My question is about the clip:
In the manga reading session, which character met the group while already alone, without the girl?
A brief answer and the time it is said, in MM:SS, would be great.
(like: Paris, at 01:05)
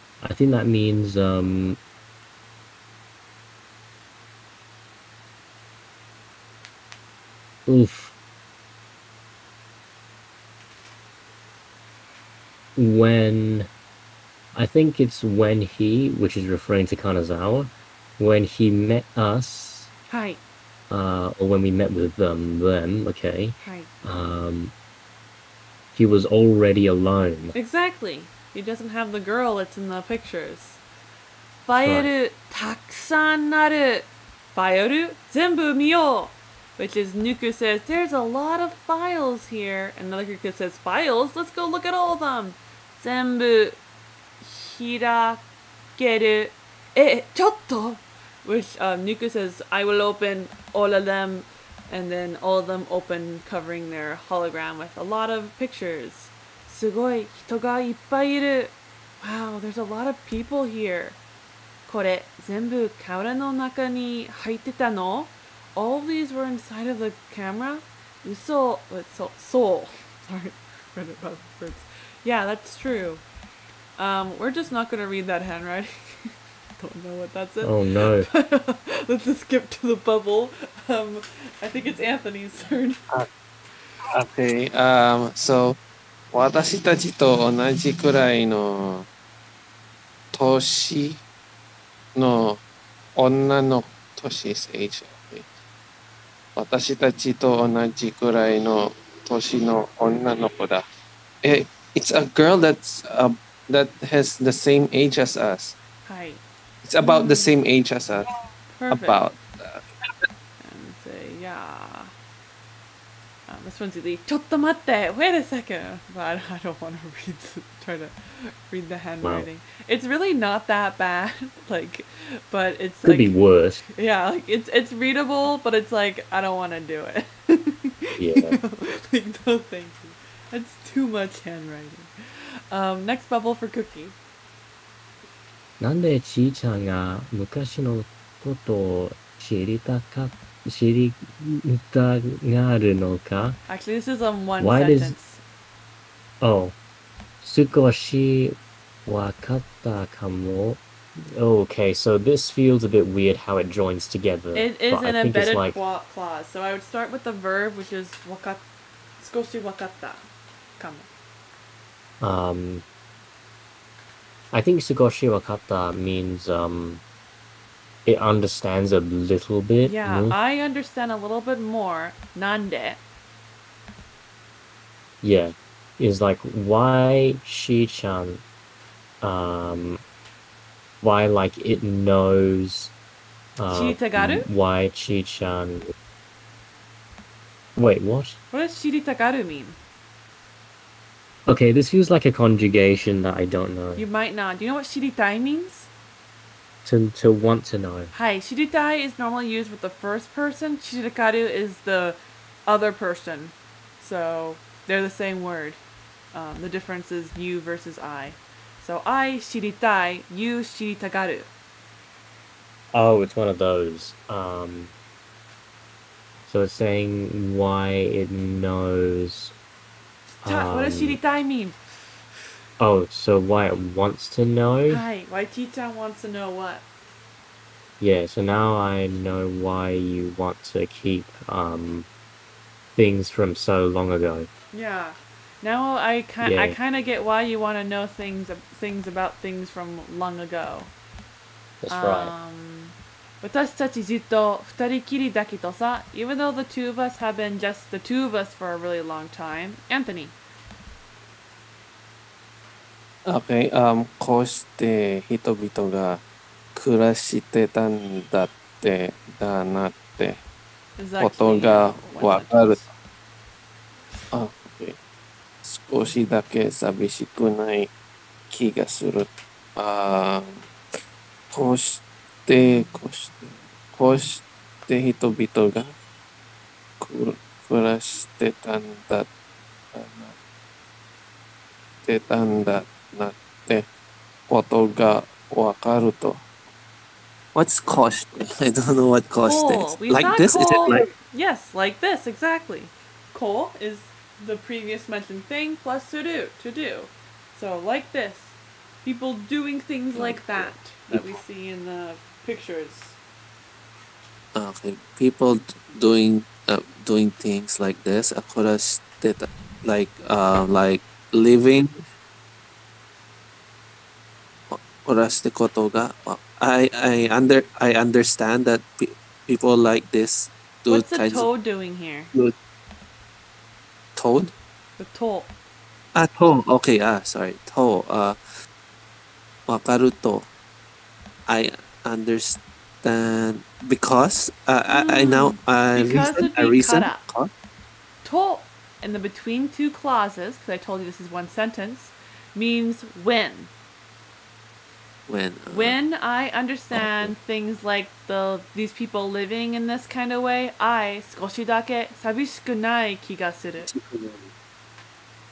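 Kanazawa, at 00:16.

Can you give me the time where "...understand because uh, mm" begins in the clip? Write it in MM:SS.
05:32.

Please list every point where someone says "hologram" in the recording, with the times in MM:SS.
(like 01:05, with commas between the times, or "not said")
00:54.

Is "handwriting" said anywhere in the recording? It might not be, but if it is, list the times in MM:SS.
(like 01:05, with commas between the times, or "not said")
01:15, 01:58, 02:11.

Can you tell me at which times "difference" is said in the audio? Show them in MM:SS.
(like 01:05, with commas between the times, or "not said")
03:26.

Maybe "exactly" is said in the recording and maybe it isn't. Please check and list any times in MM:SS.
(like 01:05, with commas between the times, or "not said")
00:27, 04:52.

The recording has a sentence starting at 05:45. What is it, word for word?
When uh, when I understand okay.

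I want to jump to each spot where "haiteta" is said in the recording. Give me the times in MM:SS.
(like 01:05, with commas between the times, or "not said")
01:04.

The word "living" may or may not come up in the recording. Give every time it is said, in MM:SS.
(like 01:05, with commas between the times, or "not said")
05:11, 05:49.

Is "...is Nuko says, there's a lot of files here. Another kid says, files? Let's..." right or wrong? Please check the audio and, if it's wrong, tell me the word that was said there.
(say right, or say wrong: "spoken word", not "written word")
right.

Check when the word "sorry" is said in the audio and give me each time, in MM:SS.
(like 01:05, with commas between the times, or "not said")
01:10, 05:27.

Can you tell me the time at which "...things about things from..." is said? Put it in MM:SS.
03:58.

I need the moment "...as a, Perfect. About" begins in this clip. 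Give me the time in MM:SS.
01:47.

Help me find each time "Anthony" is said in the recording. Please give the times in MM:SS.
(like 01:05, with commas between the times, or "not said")
01:22, 04:09.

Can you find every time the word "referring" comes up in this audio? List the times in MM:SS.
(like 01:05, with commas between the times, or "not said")
00:16.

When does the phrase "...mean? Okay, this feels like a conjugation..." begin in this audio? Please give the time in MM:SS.
03:09.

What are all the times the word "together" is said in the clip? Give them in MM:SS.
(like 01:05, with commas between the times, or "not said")
02:34.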